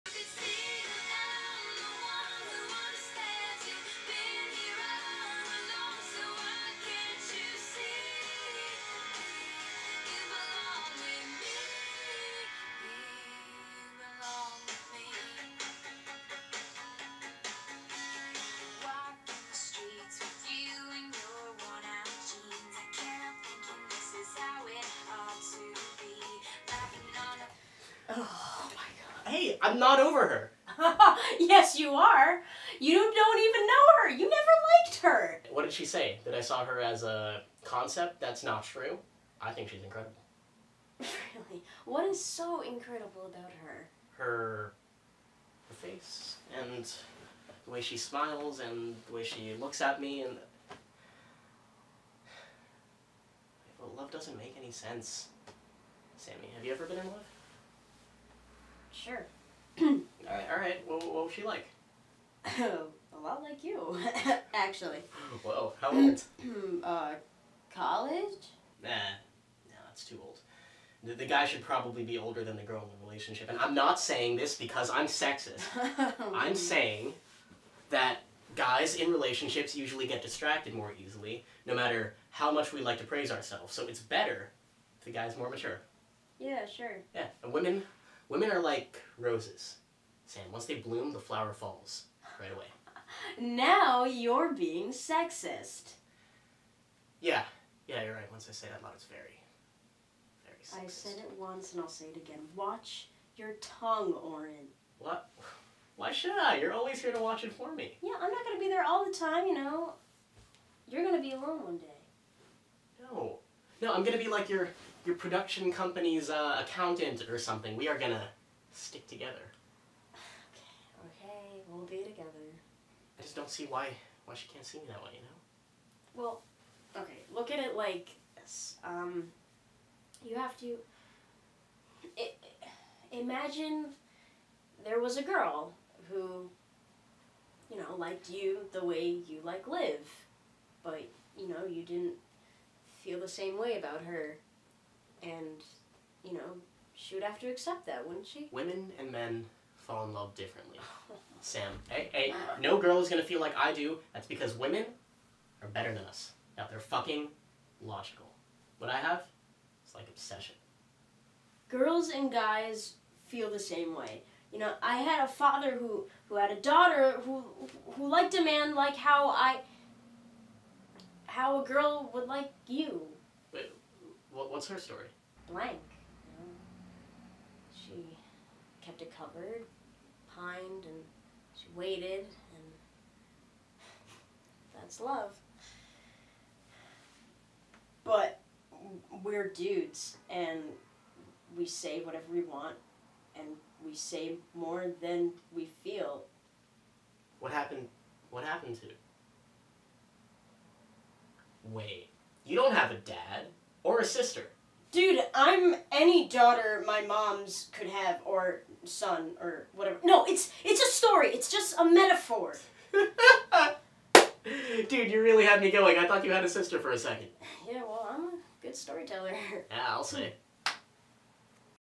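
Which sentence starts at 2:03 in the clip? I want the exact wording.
I just don't see why why she can't see me that way, you know?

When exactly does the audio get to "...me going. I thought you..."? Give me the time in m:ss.
3:35.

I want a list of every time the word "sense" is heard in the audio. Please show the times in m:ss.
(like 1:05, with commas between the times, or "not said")
0:54.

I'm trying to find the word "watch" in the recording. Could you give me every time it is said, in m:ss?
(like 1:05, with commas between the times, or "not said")
1:42, 1:47.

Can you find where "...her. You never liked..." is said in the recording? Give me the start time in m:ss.
0:34.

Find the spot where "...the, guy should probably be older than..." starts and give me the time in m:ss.
1:11.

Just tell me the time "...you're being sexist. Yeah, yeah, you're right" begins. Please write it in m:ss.
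1:34.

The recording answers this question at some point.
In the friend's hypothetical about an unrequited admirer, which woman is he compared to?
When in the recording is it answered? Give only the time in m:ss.
2:19.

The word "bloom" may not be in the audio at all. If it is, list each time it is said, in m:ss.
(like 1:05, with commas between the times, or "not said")
1:30.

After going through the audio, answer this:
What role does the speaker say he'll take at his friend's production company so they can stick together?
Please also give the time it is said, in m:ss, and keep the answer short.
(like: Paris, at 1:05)
Accountant, at 1:56.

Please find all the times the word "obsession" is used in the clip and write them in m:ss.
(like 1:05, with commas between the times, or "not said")
2:40.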